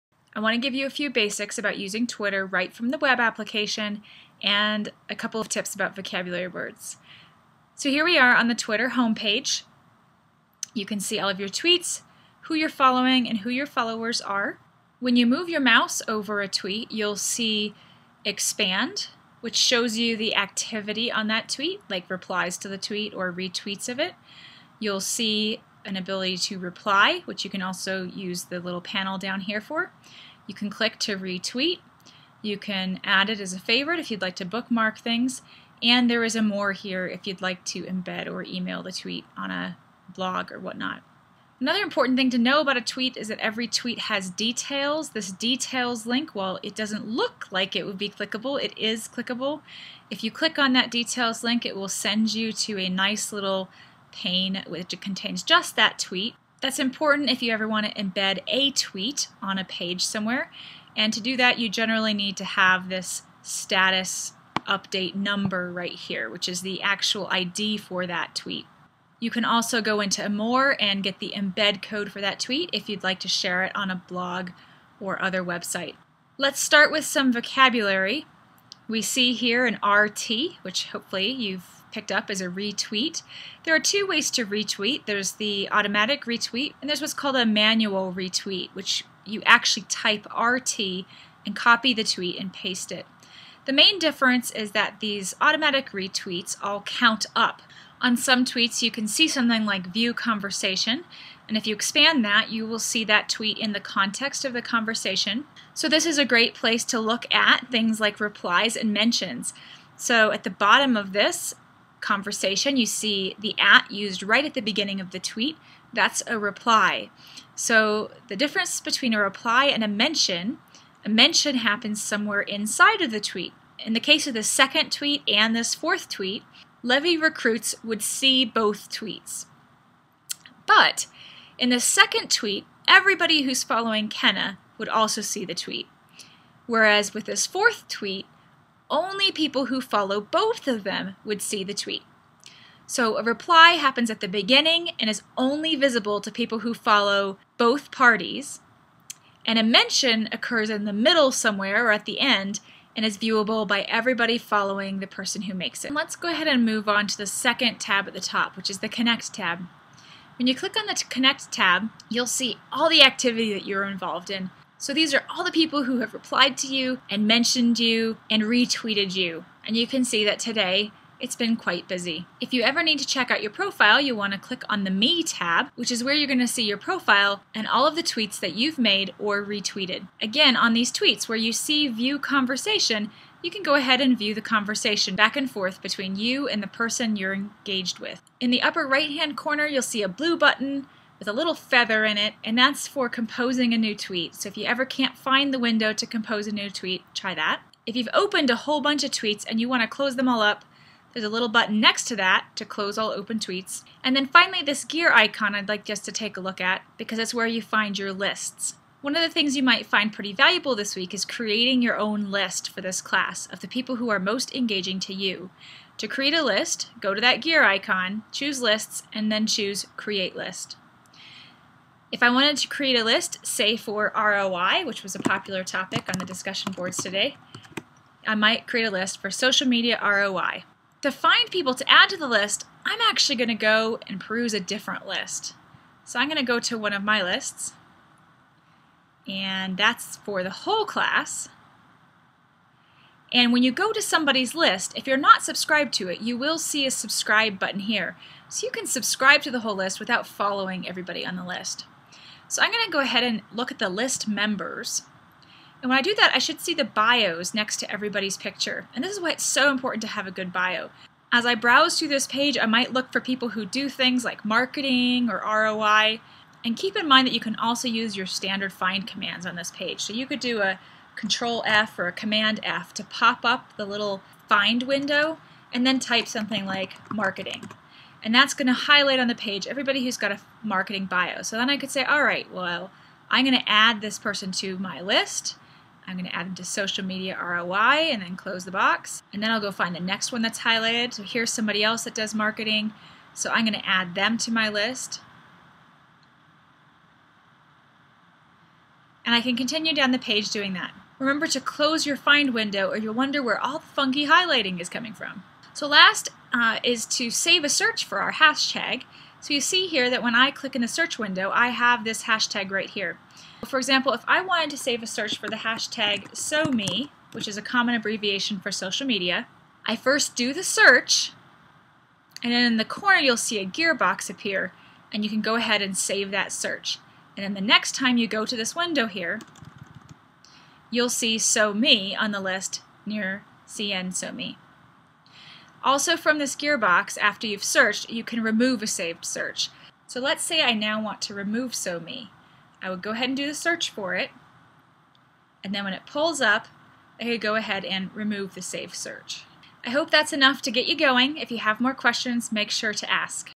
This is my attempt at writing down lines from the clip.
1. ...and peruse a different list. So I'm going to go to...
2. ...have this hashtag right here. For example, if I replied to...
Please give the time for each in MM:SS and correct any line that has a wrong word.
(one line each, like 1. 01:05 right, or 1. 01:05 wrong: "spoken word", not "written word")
1. 03:54 right
2. 05:11 wrong: "wanted", not "replied".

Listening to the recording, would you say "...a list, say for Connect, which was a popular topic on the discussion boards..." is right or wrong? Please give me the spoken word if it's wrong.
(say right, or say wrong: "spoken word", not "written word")
wrong: "ROI", not "Connect".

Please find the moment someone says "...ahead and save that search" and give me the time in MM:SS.
05:25.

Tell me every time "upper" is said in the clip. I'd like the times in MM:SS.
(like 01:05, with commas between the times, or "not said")
03:08.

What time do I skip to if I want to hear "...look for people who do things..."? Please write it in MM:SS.
04:22.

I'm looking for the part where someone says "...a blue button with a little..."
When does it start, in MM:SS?
03:10.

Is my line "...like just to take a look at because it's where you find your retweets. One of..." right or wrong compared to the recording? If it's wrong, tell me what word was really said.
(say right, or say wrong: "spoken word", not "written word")
wrong: "lists", not "retweets".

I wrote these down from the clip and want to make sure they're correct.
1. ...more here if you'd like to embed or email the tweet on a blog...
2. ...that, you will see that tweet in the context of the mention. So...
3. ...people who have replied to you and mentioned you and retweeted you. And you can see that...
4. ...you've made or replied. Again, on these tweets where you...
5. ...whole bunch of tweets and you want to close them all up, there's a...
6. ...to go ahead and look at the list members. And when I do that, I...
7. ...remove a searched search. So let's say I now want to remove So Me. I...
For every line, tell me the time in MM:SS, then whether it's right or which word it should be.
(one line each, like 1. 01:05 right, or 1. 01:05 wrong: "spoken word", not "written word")
1. 00:36 right
2. 01:42 wrong: "conversation", not "mention"
3. 02:45 right
4. 02:58 wrong: "retweeted", not "replied"
5. 03:18 right
6. 04:12 right
7. 05:38 wrong: "saved", not "searched".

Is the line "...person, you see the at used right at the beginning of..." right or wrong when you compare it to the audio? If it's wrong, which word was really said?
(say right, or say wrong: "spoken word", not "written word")
wrong: "conversation", not "person".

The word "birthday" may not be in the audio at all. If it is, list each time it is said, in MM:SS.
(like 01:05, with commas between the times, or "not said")
not said.